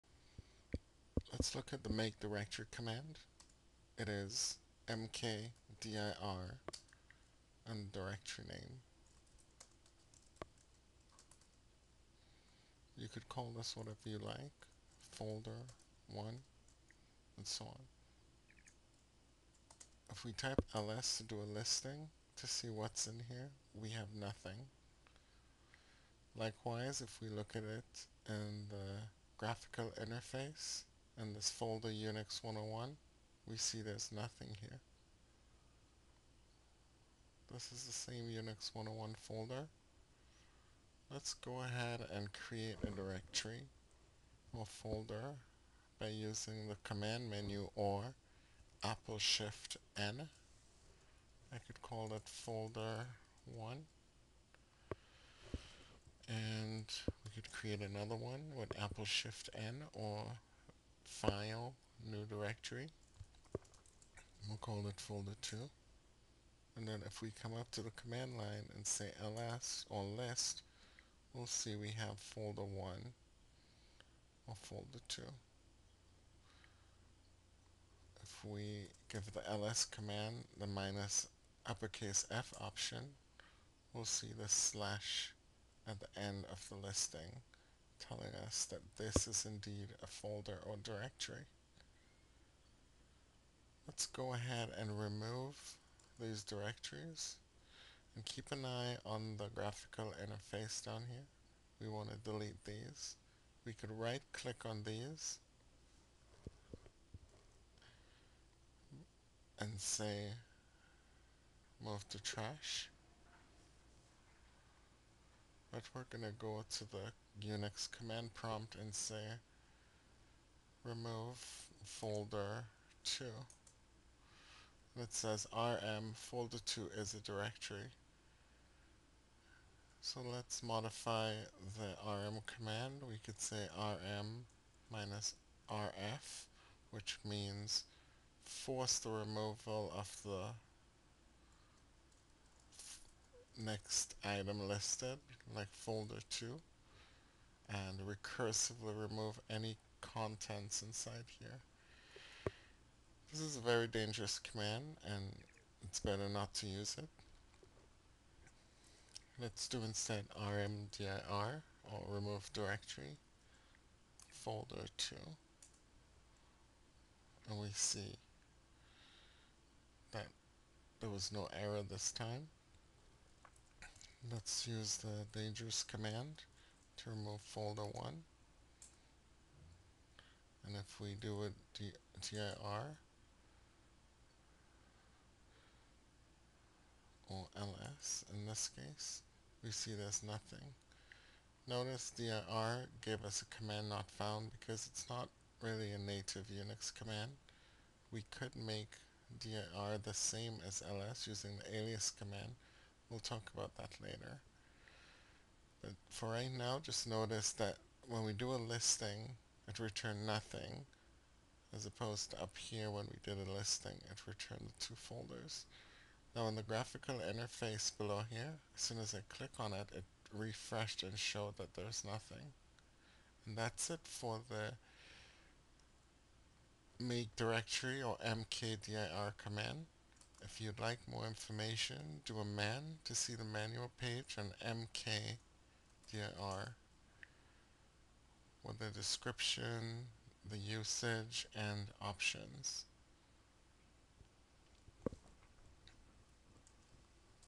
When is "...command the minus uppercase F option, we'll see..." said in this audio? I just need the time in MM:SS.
01:19.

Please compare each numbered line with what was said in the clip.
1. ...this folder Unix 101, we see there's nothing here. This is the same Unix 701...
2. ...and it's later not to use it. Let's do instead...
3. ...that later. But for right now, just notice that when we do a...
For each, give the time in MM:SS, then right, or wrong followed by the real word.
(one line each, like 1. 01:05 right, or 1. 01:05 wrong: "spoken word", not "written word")
1. 00:31 wrong: "101", not "701"
2. 02:35 wrong: "better", not "later"
3. 03:23 right.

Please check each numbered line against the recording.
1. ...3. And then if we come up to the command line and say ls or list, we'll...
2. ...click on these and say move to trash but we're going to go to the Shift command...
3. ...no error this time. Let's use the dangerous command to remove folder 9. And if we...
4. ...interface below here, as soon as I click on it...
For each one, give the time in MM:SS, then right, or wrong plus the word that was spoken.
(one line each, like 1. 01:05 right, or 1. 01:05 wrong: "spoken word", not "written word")
1. 01:05 wrong: "2", not "3"
2. 01:44 wrong: "Unix", not "Shift"
3. 02:51 wrong: "1", not "9"
4. 03:37 right.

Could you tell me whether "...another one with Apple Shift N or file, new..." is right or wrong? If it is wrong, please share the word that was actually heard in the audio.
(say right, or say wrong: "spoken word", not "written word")
right.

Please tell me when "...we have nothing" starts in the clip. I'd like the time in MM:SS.
00:23.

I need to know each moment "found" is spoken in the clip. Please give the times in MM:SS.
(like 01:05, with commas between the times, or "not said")
03:14.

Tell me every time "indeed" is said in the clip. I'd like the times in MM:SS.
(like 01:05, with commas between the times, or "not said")
01:29.